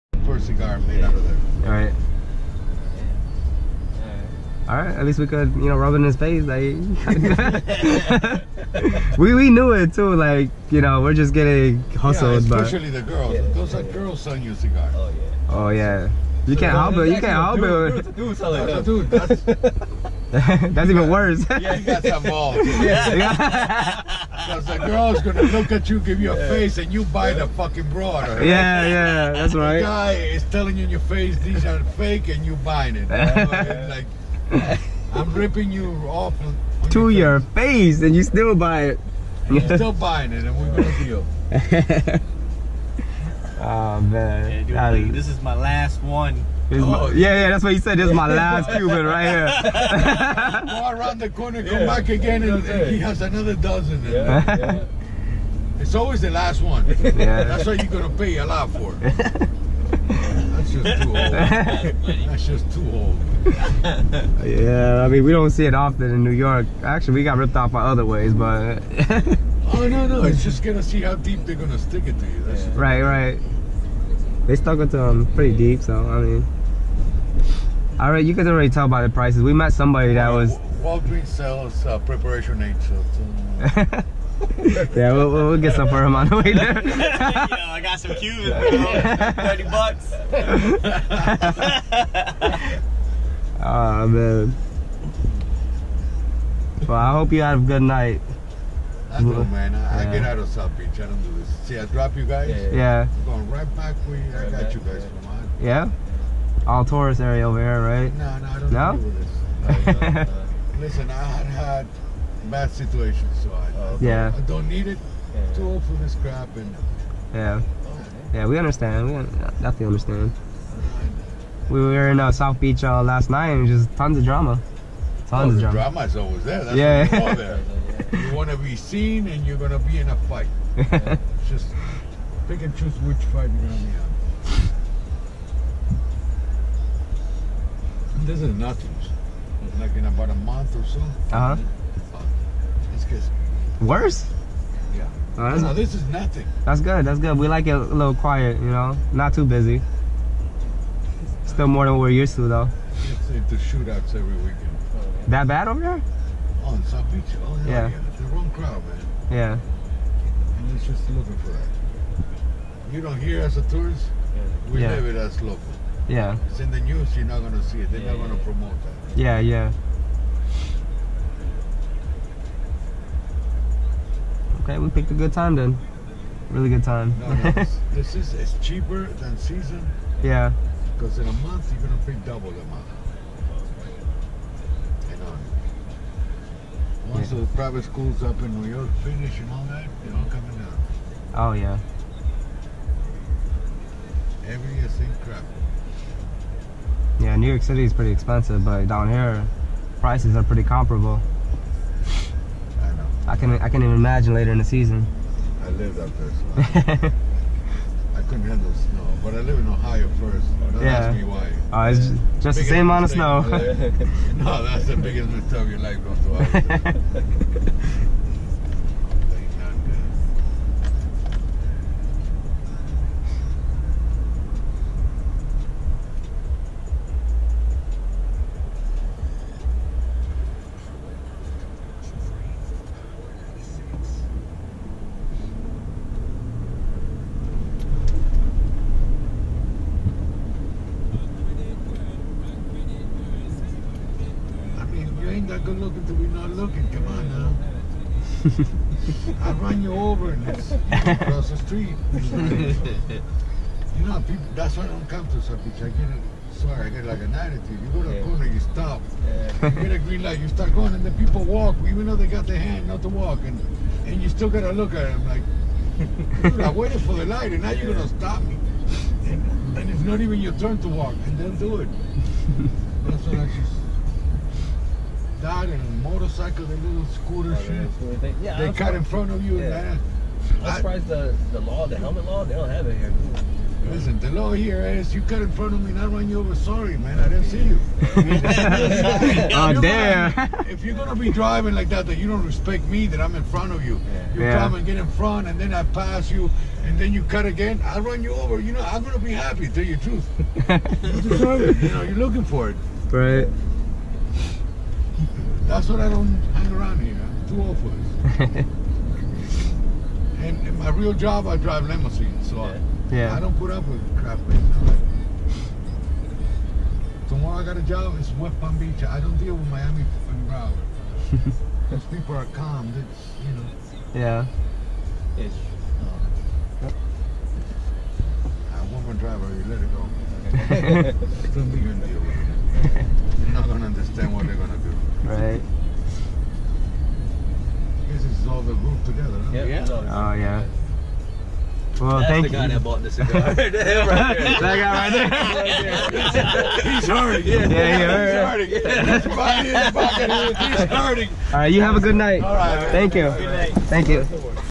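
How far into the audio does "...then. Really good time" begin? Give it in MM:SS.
02:55.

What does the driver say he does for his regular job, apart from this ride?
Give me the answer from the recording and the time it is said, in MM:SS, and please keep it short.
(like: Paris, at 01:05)
Drive limousines, at 05:11.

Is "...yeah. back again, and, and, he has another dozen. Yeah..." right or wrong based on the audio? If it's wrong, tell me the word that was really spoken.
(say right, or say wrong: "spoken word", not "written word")
right.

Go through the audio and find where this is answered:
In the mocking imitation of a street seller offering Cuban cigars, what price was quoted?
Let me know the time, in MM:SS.
01:29.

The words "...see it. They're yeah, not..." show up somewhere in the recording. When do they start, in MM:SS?
02:47.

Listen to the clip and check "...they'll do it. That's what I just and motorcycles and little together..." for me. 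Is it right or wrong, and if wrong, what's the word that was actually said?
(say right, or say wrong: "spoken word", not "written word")
wrong: "scooter", not "together".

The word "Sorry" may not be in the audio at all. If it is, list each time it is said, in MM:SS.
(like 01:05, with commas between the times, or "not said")
04:16, 04:46.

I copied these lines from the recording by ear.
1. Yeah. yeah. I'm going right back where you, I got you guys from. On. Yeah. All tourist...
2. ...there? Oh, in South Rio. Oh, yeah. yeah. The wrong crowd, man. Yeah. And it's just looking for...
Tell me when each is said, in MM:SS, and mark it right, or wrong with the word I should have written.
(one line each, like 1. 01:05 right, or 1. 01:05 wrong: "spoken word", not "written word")
1. 01:42 right
2. 02:35 wrong: "Beach", not "Rio".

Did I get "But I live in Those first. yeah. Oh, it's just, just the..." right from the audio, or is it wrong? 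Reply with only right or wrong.
wrong.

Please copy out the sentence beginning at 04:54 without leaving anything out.
come and get in front and then I pass you and then you cut again, I run you over.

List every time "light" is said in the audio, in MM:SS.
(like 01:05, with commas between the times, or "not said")
04:20, 04:27.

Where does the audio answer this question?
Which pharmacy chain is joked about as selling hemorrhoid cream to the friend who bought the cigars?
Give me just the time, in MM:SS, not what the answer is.
01:20.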